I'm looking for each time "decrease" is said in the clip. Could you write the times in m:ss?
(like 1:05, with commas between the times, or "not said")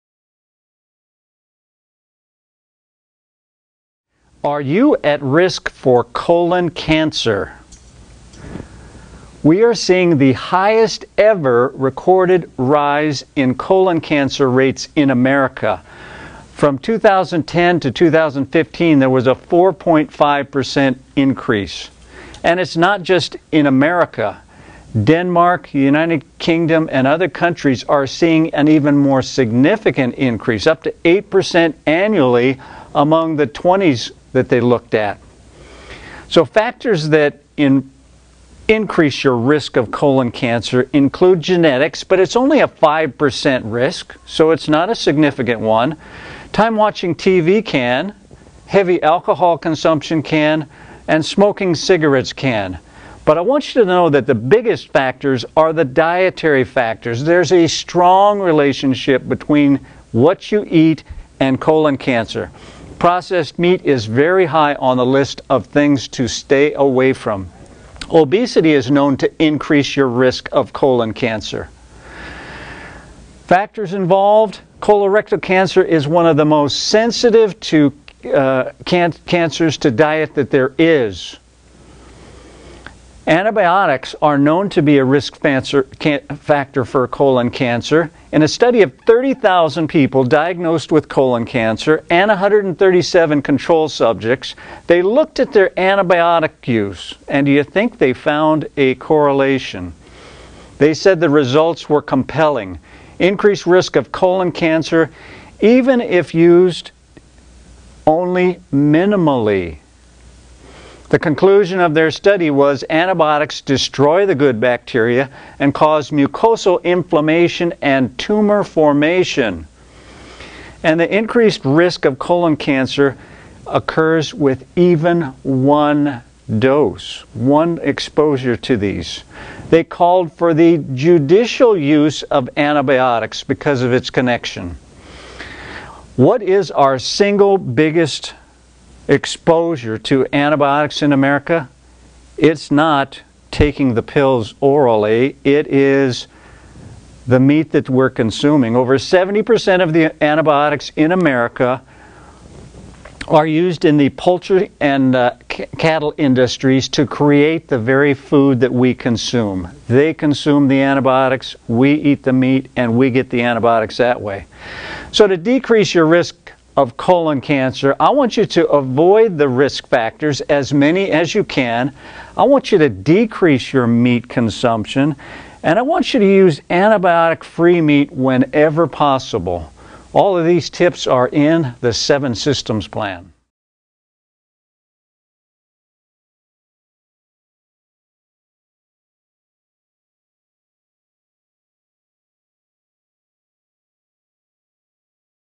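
2:45, 2:52.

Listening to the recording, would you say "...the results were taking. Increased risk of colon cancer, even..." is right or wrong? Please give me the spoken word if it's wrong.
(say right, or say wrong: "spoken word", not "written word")
wrong: "compelling", not "taking".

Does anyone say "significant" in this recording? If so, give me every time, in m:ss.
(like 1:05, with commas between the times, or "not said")
0:29, 0:44.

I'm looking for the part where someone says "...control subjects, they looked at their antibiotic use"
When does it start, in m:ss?
1:33.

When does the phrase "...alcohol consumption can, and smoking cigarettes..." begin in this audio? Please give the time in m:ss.
0:49.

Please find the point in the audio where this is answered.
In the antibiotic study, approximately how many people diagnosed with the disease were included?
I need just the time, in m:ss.
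1:29.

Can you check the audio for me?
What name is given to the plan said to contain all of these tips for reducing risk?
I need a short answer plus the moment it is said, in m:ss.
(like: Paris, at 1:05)
Seven Systems Plan, at 3:01.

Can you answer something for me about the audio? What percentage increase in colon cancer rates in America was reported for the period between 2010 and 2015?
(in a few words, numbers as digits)
4.5%.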